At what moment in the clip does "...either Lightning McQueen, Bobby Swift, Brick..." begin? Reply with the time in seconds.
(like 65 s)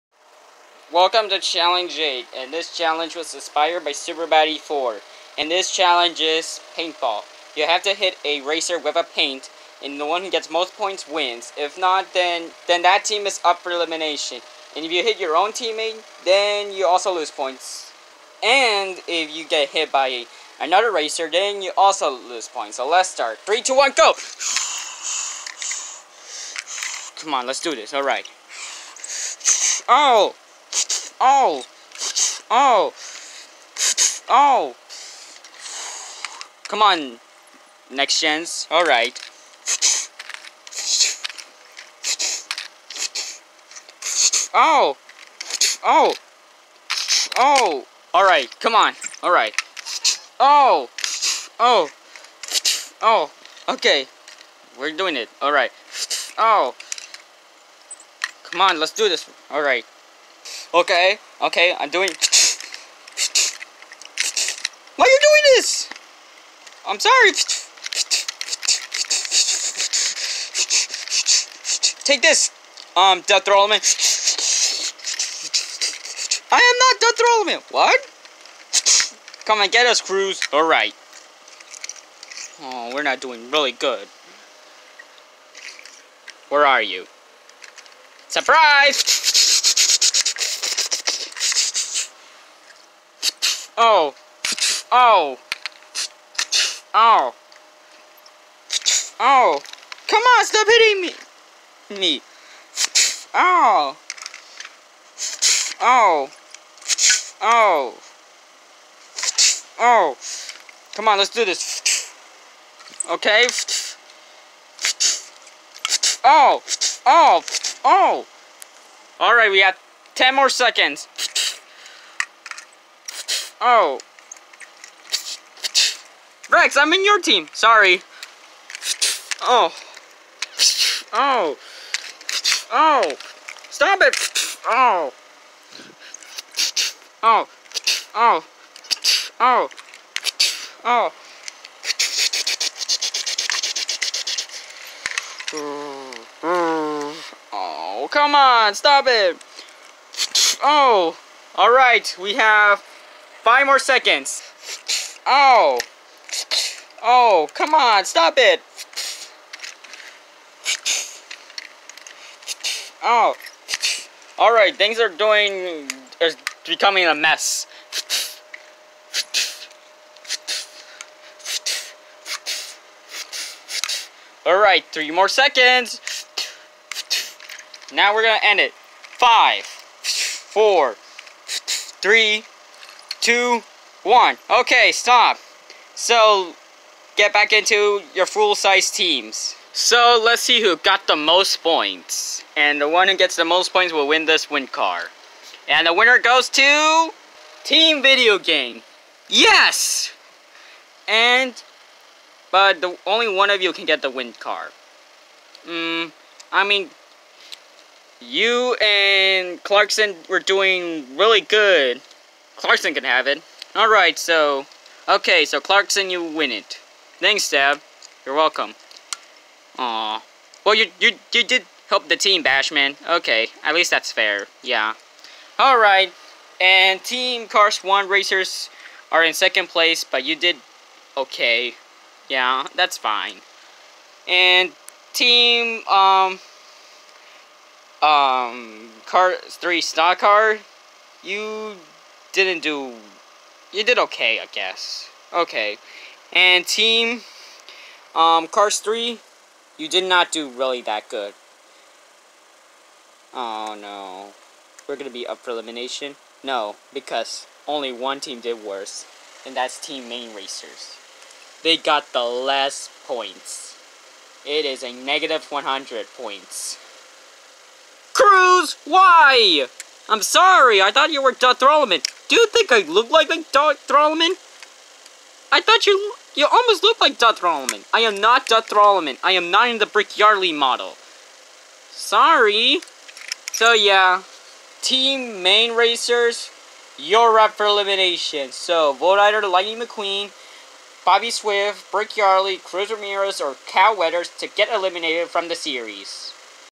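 289 s.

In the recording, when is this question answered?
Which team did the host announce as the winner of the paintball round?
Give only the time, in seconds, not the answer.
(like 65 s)
197 s.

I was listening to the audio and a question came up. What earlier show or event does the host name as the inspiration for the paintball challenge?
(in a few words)
Super Batty 4.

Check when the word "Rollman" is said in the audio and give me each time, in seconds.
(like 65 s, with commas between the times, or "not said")
73 s, 77 s.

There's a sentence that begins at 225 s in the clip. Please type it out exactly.
Alright, and Team Car Swan Racers are in second place, but you did okay.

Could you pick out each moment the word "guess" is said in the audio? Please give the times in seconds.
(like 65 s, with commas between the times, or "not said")
244 s.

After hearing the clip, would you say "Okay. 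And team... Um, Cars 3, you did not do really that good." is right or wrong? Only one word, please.
right.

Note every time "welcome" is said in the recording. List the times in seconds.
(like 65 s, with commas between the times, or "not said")
0 s, 218 s.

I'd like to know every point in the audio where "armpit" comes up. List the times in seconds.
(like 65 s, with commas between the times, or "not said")
not said.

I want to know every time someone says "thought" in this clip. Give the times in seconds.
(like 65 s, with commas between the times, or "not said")
270 s, 275 s.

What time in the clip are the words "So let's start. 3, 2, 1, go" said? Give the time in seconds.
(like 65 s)
22 s.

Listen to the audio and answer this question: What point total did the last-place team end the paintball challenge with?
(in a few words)
-100.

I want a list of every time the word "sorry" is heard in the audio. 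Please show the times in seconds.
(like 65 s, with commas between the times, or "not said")
66 s, 127 s, 270 s, 281 s.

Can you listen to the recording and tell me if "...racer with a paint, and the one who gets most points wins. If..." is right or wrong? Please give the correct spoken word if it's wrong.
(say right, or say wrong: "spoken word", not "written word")
right.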